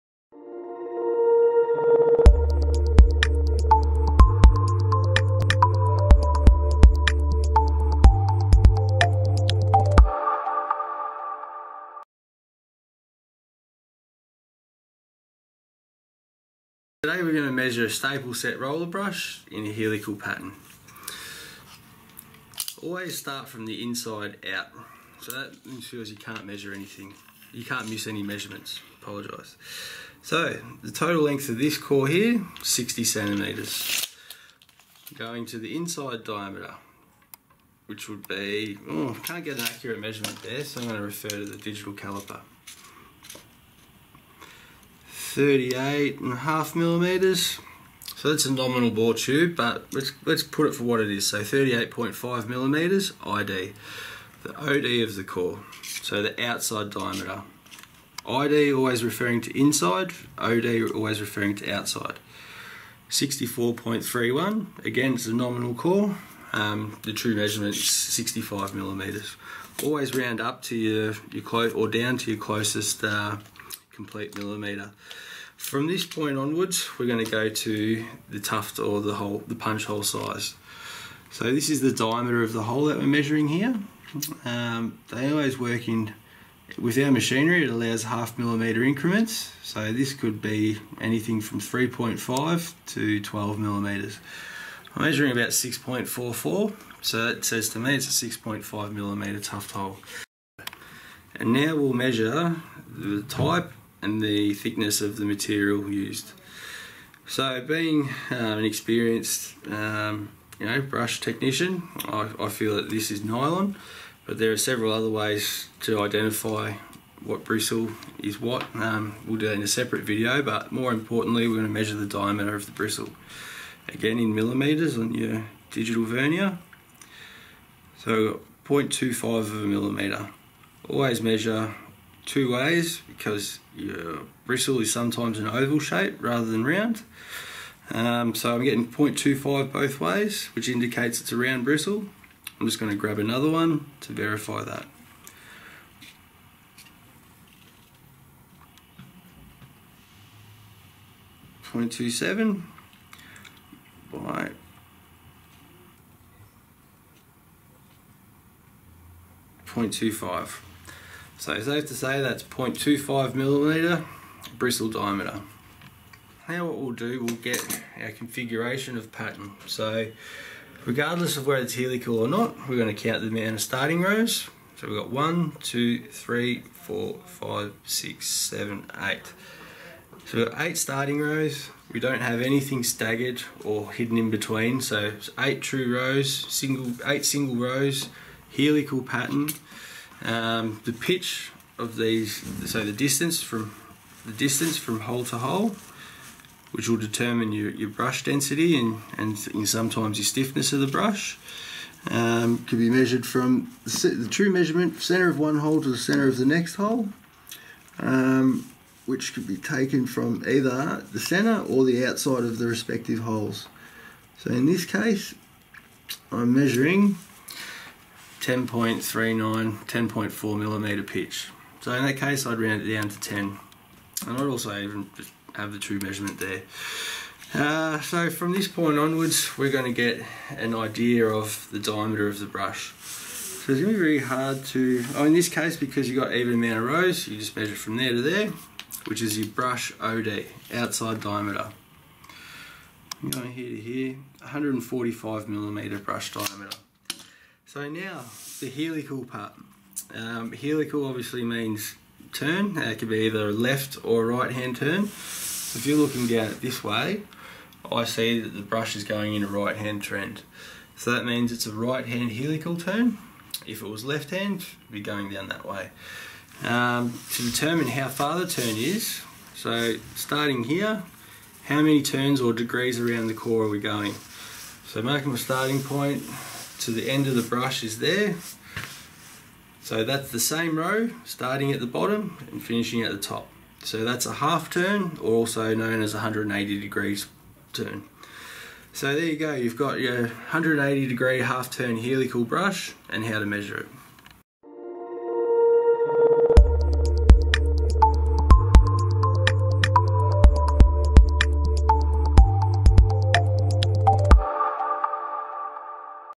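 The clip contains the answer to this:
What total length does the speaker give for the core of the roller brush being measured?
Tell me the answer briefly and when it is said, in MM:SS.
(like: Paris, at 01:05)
60 centimetres, at 00:32.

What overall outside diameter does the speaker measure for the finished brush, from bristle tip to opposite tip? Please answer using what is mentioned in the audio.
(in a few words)
145 millimeters.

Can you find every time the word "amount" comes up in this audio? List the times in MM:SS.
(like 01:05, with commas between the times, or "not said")
02:53, 03:56.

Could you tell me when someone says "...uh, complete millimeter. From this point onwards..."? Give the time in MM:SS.
01:13.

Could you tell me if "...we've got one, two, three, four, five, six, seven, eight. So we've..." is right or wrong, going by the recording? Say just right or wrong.
right.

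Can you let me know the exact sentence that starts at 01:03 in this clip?
64.31, again it's a nominal core.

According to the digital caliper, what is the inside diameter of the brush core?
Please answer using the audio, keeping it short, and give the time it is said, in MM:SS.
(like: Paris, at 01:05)
38.5 millimeters, at 00:45.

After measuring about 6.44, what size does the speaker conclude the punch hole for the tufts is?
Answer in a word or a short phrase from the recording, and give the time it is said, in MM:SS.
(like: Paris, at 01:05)
6.5 millimeters, at 01:38.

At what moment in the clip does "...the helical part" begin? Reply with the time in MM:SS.
04:08.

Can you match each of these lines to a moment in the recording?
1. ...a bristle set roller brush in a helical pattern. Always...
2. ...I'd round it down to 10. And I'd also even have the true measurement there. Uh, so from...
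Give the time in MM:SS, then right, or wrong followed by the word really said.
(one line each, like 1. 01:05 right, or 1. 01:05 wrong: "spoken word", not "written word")
1. 00:17 wrong: "staple", not "bristle"
2. 03:42 right.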